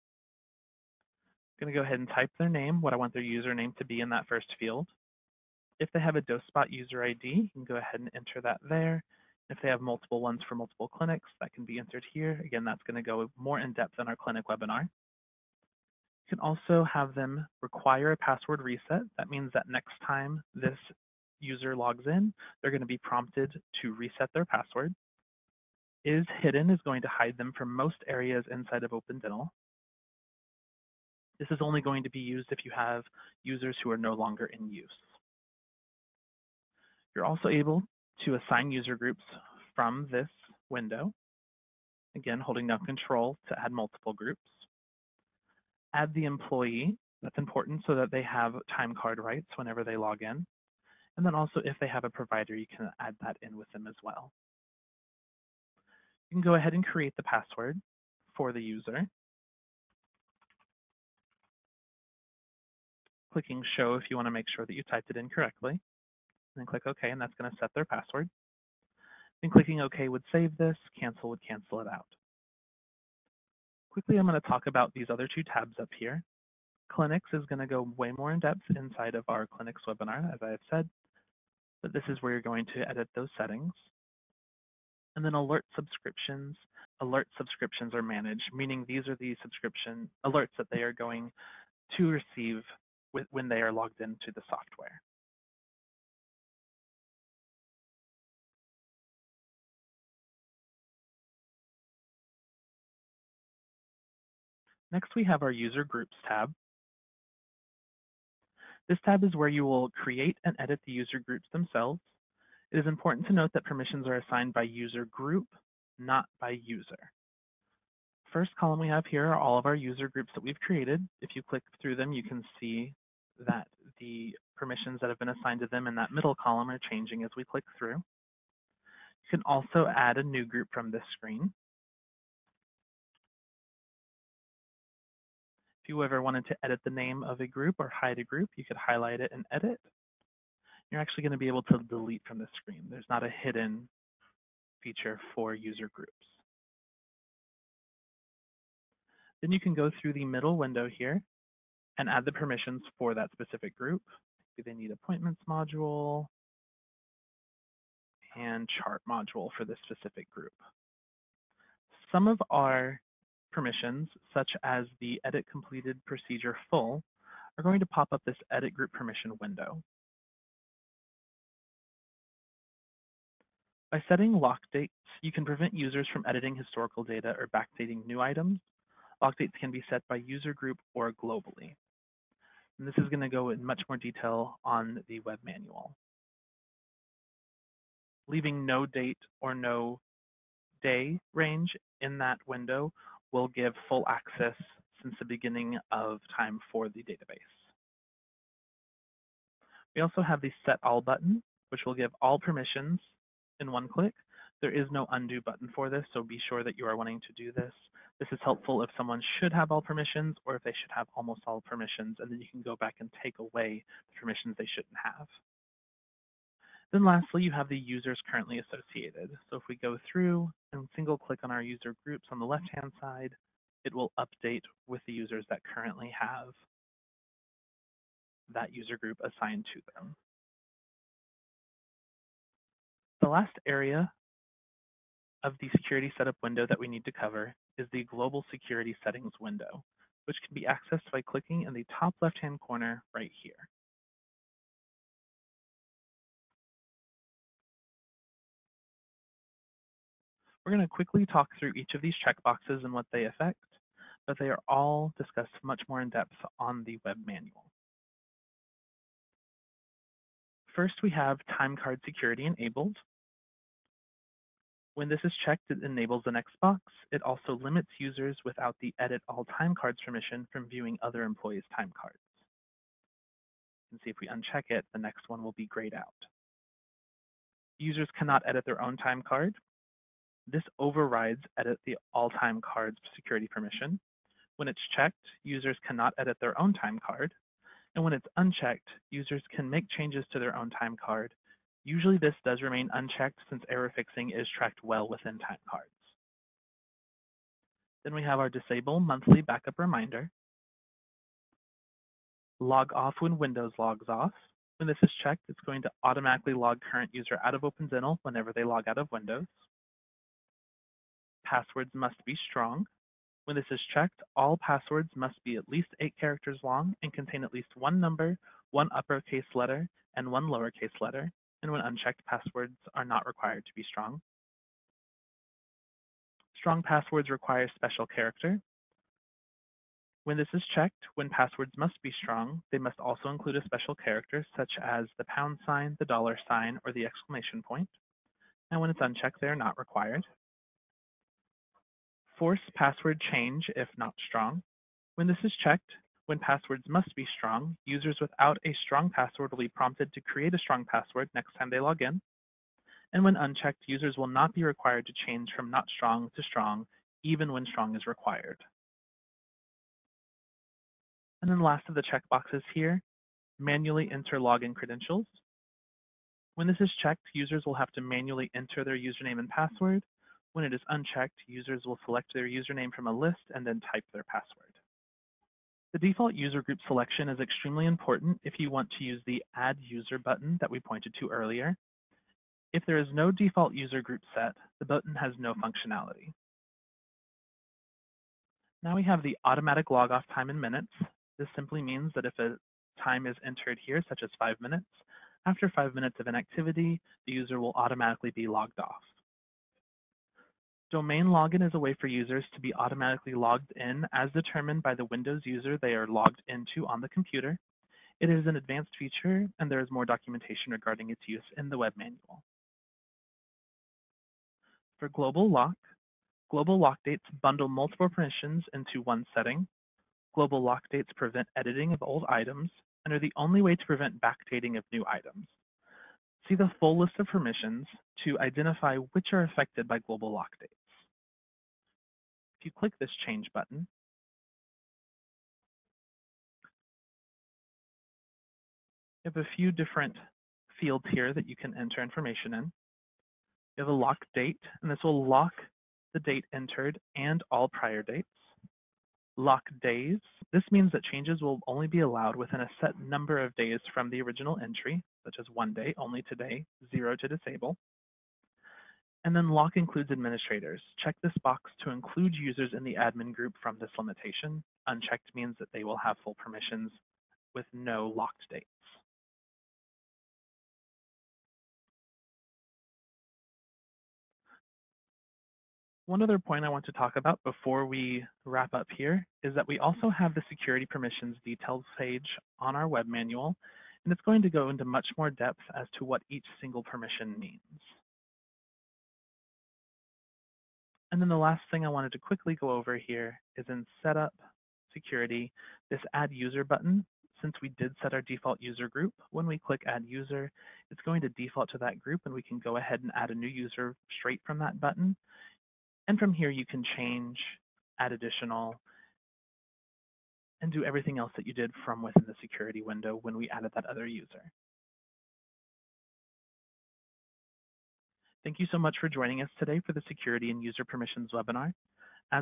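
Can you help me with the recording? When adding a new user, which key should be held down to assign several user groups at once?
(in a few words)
Control.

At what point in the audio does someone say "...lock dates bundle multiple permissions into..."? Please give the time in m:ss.
6:56.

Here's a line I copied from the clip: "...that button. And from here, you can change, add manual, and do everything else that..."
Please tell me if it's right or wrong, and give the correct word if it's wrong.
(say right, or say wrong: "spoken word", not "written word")
wrong: "additional", not "manual".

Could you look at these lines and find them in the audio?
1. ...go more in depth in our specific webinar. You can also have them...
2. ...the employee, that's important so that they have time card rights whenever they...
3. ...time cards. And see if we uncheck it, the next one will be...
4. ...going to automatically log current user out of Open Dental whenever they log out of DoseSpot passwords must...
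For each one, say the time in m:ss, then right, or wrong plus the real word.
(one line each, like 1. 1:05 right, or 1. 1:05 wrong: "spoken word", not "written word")
1. 0:13 wrong: "clinic", not "specific"
2. 0:46 right
3. 4:31 right
4. 5:05 wrong: "Windows", not "DoseSpot".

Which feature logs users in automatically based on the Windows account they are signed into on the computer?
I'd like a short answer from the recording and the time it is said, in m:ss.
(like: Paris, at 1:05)
Domain login, at 6:40.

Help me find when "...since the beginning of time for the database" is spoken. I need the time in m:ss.
3:15.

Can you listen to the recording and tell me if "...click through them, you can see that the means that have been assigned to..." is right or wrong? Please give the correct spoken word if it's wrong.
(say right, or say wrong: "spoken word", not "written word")
wrong: "permissions", not "means".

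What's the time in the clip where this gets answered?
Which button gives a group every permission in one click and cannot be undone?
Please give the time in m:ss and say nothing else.
3:20.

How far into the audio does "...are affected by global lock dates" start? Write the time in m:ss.
7:09.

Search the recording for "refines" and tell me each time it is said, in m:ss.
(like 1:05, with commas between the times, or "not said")
not said.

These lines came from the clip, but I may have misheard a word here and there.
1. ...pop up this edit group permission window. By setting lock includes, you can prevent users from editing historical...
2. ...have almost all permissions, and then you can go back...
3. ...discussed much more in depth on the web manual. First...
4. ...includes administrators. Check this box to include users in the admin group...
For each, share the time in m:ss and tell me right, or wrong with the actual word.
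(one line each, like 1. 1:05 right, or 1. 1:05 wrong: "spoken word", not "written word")
1. 2:47 wrong: "dates", not "includes"
2. 3:30 right
3. 4:15 right
4. 7:39 right.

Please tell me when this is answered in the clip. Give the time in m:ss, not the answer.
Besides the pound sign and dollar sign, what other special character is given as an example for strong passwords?
5:36.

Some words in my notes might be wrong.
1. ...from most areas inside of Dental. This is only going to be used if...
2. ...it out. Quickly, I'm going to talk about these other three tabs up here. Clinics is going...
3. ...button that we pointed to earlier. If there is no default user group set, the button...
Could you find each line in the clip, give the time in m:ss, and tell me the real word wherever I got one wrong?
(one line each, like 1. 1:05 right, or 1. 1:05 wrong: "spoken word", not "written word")
1. 0:27 right
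2. 1:11 wrong: "two", not "three"
3. 6:20 right.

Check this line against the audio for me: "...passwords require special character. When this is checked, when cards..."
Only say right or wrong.
wrong.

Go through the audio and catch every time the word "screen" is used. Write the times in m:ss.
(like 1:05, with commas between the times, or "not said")
2:11, 2:22.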